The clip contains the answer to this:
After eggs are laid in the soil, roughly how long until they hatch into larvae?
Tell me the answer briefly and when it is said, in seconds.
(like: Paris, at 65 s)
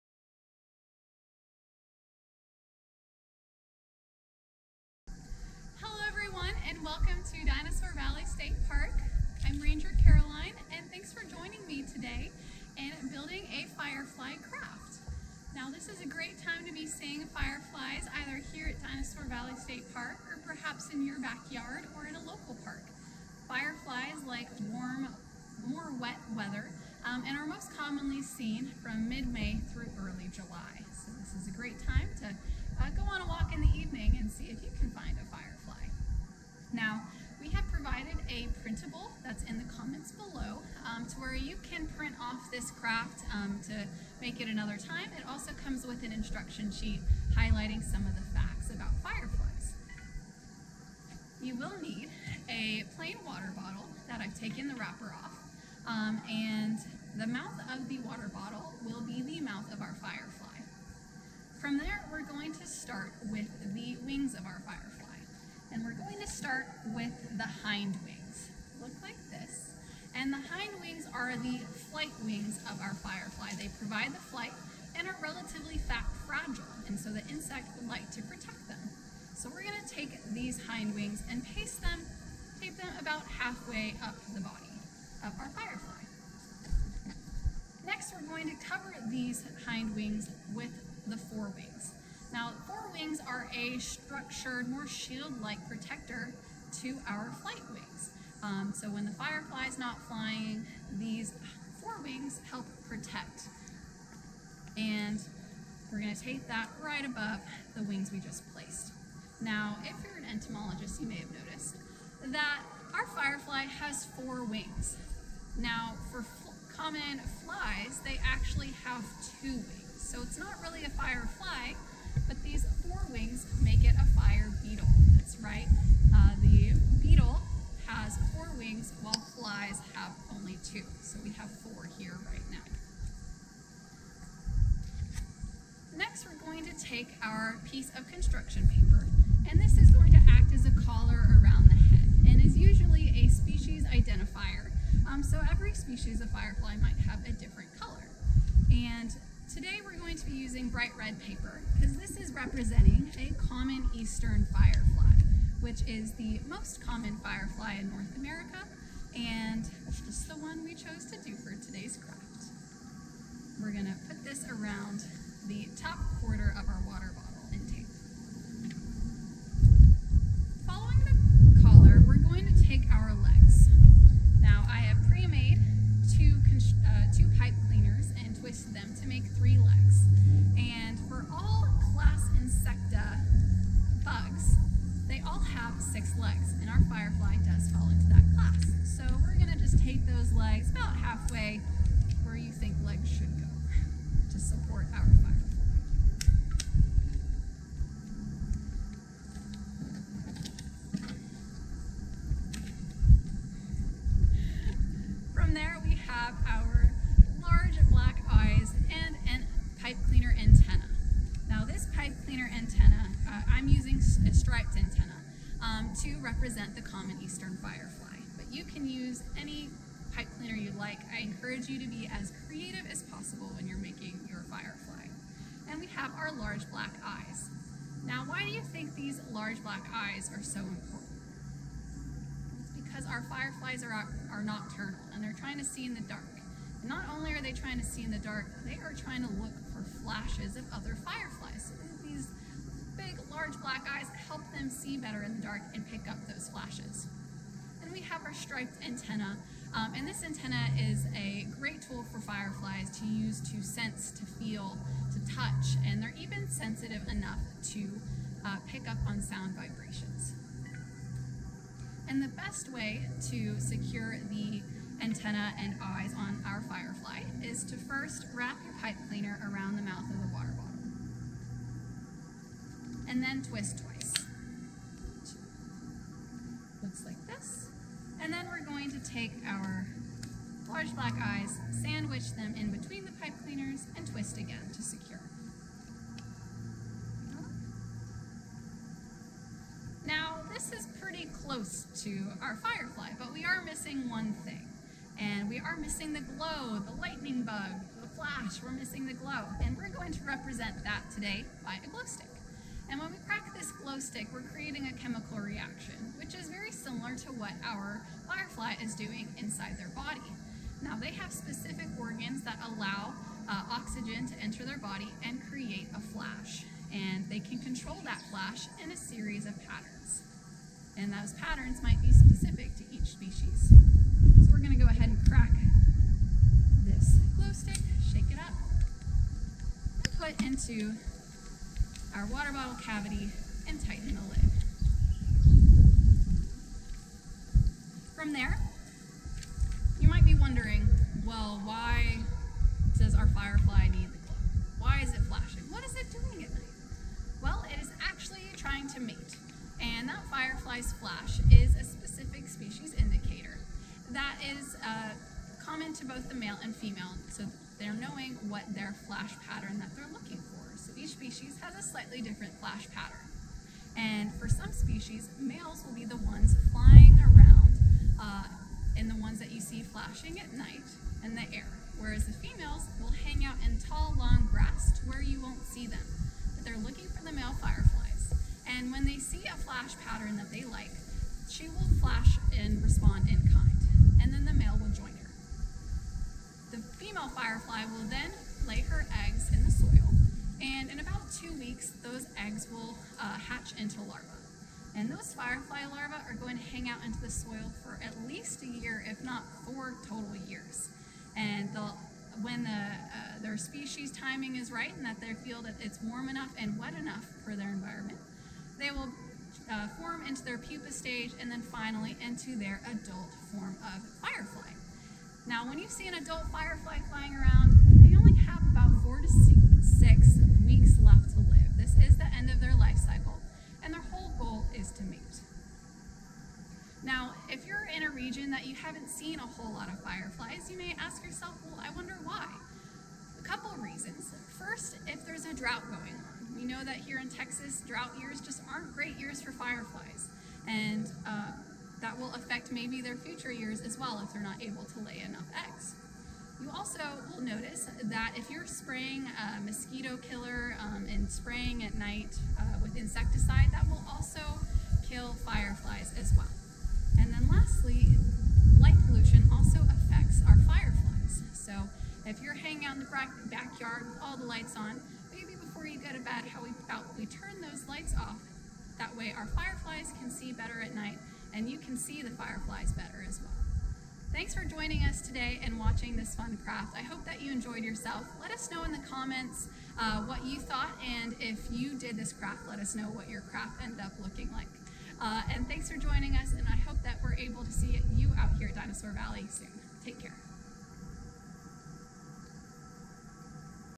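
2 weeks, at 391 s.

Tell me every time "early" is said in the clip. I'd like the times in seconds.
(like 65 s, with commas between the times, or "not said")
30 s.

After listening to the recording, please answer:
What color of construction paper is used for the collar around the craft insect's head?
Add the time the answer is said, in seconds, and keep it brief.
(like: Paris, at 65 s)
bright red, at 150 s.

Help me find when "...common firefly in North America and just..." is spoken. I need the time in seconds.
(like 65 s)
156 s.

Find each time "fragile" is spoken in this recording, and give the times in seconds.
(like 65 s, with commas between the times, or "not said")
76 s.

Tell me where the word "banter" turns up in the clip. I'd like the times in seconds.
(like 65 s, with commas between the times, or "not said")
not said.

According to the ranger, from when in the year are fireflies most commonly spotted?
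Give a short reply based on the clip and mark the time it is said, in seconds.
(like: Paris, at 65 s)
mid-May, at 29 s.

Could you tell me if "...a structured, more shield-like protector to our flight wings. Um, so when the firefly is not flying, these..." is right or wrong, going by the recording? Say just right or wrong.
right.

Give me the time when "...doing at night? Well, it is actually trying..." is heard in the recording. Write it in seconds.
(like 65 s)
346 s.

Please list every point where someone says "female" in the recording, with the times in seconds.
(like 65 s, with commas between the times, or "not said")
356 s, 372 s, 386 s.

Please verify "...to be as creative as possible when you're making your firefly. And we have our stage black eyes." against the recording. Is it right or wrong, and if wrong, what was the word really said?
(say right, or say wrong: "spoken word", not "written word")
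wrong: "large", not "stage".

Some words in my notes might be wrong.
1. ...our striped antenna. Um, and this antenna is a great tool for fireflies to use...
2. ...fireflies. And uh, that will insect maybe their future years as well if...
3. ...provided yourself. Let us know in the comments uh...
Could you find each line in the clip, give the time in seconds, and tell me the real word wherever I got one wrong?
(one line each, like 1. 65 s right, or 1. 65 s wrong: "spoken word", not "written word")
1. 248 s right
2. 439 s wrong: "affect", not "insect"
3. 477 s wrong: "enjoyed", not "provided".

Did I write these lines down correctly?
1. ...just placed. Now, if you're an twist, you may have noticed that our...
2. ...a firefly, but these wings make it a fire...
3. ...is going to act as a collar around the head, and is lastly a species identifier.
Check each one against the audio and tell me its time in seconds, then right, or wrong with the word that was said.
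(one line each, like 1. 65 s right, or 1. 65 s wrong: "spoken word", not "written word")
1. 108 s wrong: "entomologist", not "twist"
2. 120 s right
3. 139 s wrong: "usually", not "lastly".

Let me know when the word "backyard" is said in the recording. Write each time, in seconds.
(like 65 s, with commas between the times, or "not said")
21 s, 463 s.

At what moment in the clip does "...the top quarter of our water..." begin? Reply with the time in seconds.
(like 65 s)
165 s.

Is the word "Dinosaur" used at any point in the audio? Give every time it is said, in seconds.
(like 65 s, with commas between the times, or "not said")
7 s, 18 s, 488 s.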